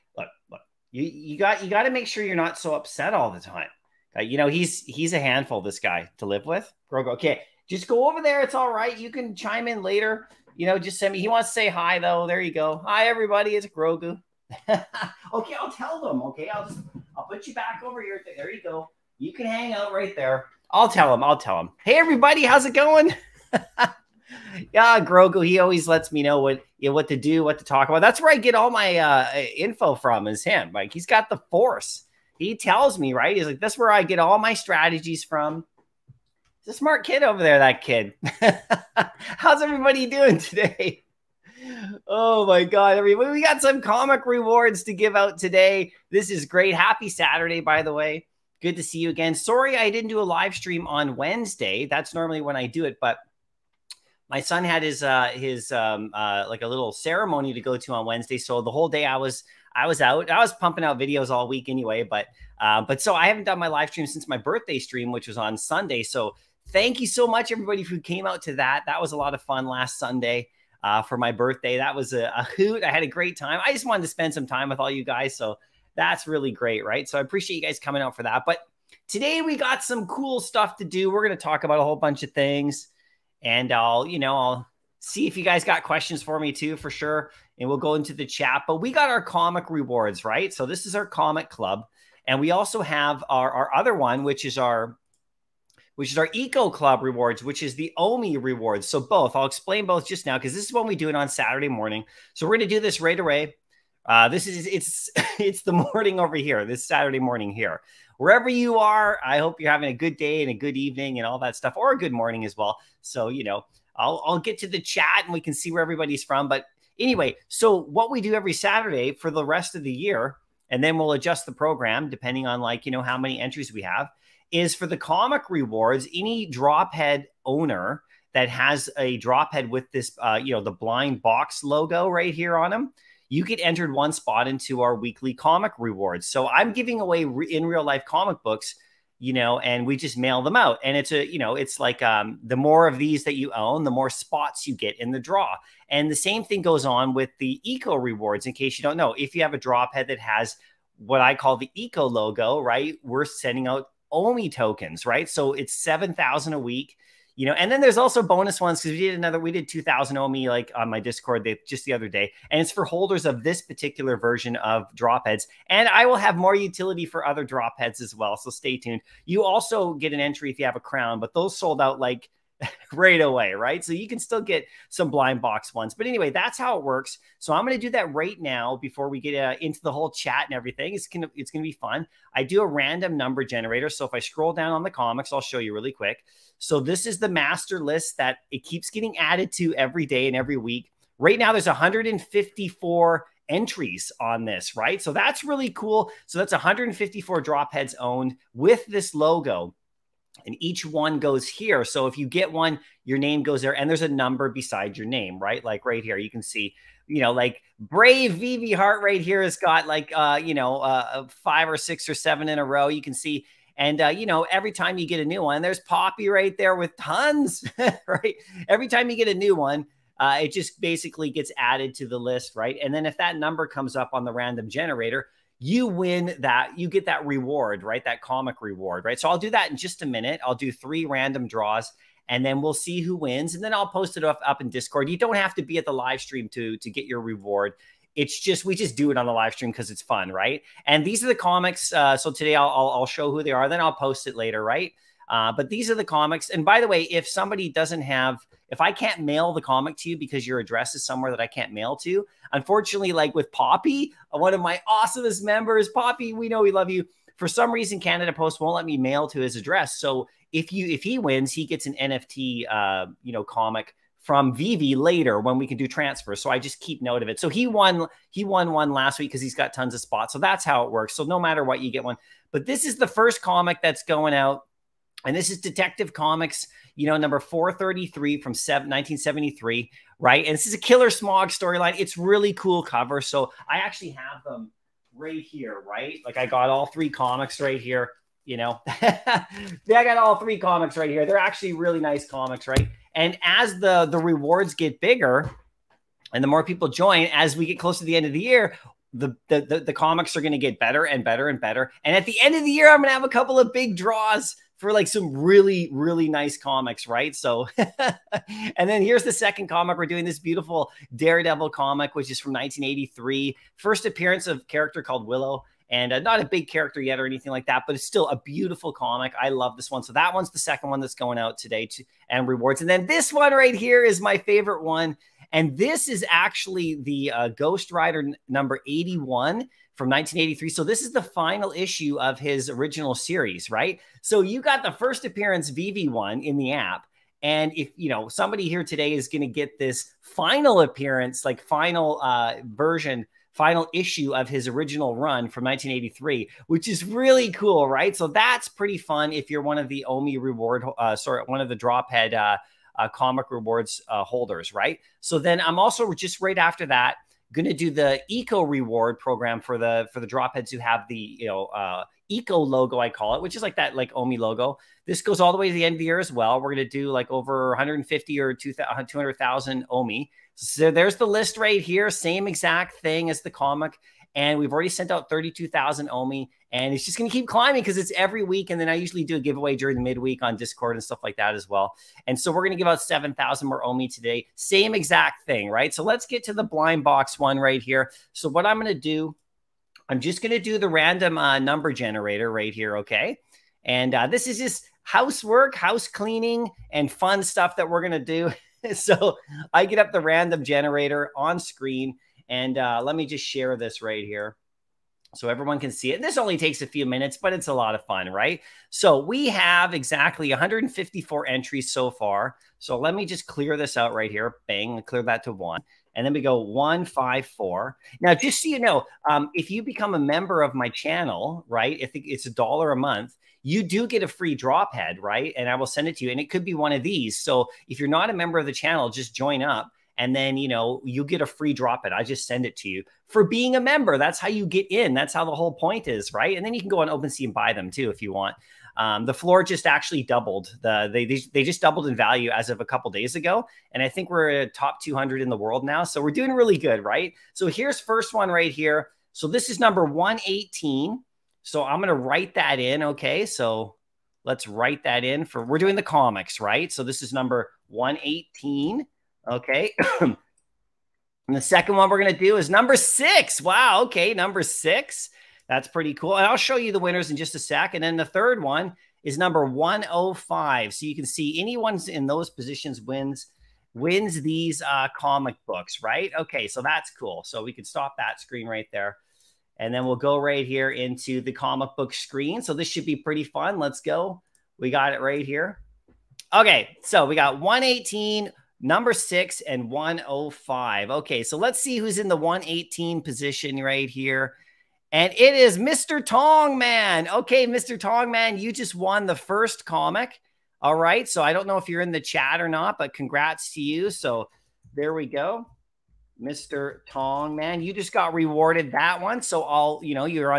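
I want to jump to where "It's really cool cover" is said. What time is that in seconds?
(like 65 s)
281 s.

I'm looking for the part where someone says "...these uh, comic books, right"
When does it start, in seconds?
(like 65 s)
474 s.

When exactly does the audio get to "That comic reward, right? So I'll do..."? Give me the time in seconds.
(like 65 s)
228 s.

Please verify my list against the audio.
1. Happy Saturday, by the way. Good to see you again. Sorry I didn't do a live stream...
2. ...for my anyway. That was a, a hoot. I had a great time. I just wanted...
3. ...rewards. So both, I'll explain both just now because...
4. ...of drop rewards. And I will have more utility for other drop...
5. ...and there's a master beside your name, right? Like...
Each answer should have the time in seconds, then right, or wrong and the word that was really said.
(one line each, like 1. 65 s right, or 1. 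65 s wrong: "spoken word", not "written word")
1. 46 s right
2. 71 s wrong: "birthday", not "anyway"
3. 98 s right
4. 164 s wrong: "heads", not "rewards"
5. 203 s wrong: "number", not "master".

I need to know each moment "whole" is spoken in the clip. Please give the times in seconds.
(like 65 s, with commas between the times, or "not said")
58 s, 81 s, 179 s, 435 s.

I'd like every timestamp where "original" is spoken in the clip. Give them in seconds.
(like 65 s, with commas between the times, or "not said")
332 s, 344 s.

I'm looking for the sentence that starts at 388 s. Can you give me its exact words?
So what I'm going to do, I'm just going to do the random uh, number generator right here, okay?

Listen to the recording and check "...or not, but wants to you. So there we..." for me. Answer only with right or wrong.
wrong.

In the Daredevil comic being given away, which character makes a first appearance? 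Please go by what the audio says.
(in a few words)
Willow.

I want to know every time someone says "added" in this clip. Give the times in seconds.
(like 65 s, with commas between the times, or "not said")
189 s, 221 s.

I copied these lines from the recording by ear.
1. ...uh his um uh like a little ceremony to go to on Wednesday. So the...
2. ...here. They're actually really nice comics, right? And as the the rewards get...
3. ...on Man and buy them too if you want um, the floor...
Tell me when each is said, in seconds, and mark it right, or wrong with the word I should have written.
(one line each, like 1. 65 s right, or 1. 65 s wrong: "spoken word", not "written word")
1. 55 s right
2. 291 s right
3. 436 s wrong: "OpenSea", not "Man".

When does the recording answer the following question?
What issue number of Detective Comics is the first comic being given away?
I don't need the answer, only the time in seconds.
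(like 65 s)
277 s.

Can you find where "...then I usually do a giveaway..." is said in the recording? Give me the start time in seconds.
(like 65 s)
378 s.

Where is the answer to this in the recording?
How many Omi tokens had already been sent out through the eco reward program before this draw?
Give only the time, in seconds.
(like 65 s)
375 s.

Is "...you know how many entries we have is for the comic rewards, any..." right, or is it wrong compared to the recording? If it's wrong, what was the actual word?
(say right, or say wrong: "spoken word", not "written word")
right.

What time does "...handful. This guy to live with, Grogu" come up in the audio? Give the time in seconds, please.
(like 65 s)
5 s.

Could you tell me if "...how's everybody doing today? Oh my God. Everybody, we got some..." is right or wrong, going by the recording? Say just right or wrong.
right.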